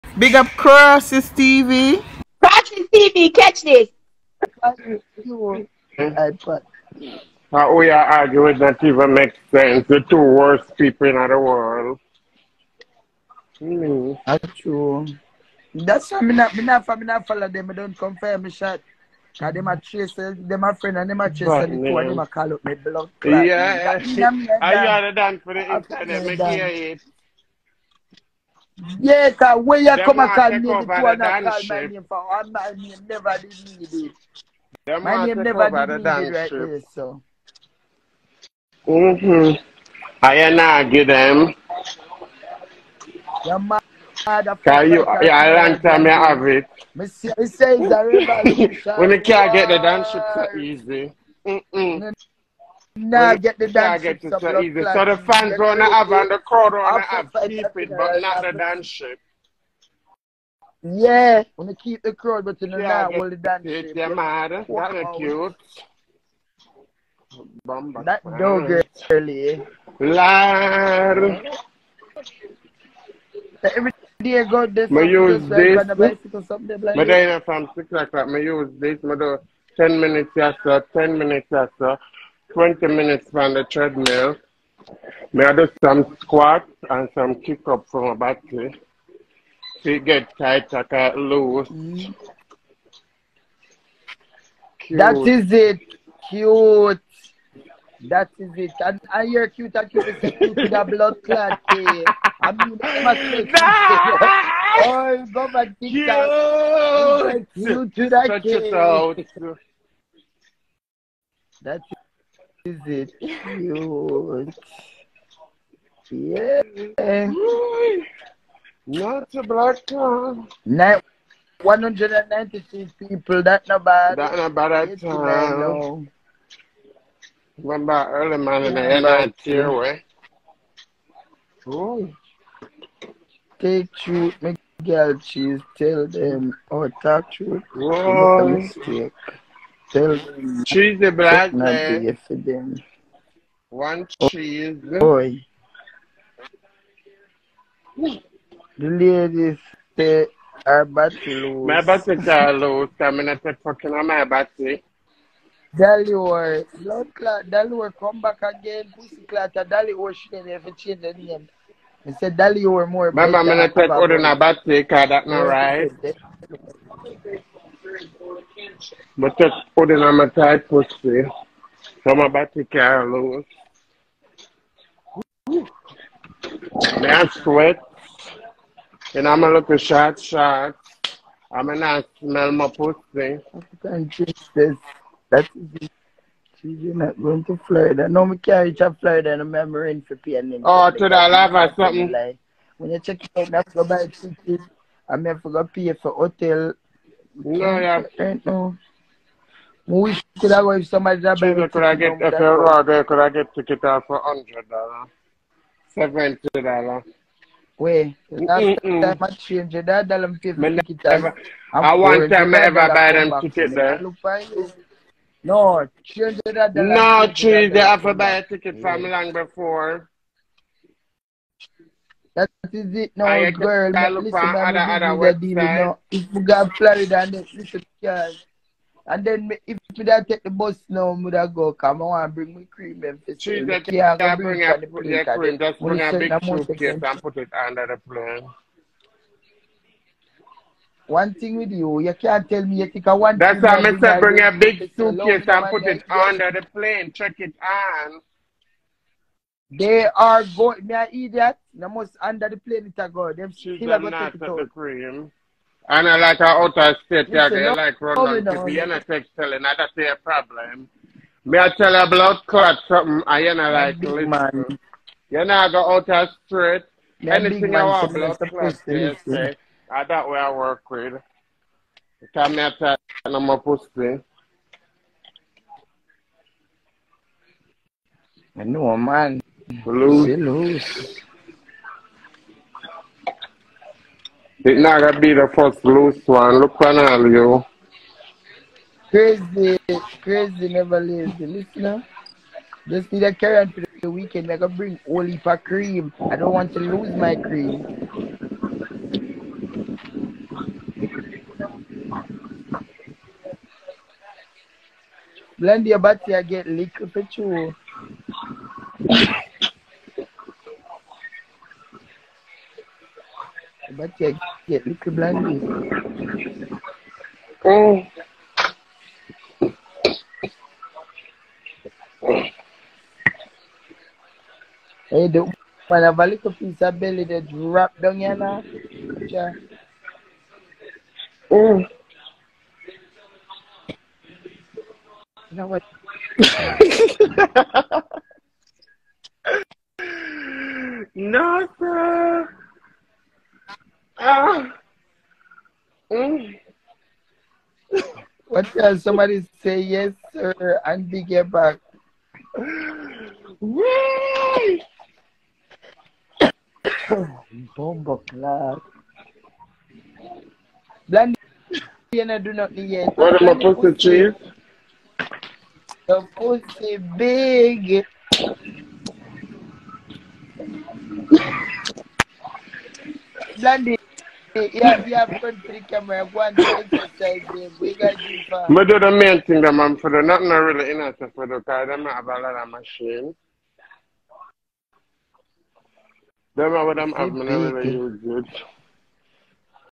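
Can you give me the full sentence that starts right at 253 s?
Them still are going to take it out.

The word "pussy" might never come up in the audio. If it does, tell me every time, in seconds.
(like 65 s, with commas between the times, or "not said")
158 s, 182 s, 273 s, 366 s.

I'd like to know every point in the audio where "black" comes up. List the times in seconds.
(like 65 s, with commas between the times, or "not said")
119 s, 141 s.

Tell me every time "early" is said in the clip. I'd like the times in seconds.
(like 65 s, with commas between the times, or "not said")
69 s, 128 s.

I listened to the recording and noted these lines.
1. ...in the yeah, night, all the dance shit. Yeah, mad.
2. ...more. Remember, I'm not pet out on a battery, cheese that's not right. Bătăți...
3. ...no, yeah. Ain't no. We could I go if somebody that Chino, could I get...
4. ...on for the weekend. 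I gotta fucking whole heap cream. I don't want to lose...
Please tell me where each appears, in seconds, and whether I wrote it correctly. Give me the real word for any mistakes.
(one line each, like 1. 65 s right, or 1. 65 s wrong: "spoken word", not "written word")
1. 62 s right
2. 162 s wrong: "cause", not "cheese"
3. 197 s right
4. 293 s wrong: "bring", not "fucking".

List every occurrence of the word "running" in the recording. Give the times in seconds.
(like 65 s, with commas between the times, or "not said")
258 s.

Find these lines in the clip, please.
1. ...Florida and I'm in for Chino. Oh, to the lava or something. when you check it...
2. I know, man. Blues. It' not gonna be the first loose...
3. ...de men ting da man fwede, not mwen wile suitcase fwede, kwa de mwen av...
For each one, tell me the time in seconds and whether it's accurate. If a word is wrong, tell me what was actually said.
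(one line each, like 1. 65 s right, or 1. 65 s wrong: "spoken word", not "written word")
1. 189 s wrong: "PNN", not "Chino"
2. 278 s right
3. 378 s wrong: "inase", not "suitcase".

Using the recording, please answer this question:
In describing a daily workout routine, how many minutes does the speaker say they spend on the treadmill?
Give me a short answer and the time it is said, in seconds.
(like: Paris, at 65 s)
20, at 82 s.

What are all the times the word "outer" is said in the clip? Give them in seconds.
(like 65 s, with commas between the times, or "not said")
256 s, 265 s.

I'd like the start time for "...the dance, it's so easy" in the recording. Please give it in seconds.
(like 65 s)
49 s.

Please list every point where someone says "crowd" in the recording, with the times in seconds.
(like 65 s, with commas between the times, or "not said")
56 s, 62 s.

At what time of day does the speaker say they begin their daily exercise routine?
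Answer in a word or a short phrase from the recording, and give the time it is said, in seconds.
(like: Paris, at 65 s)
6 o'clock, at 77 s.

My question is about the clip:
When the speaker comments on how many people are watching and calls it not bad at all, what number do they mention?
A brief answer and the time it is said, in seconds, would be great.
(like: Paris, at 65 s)
196, at 121 s.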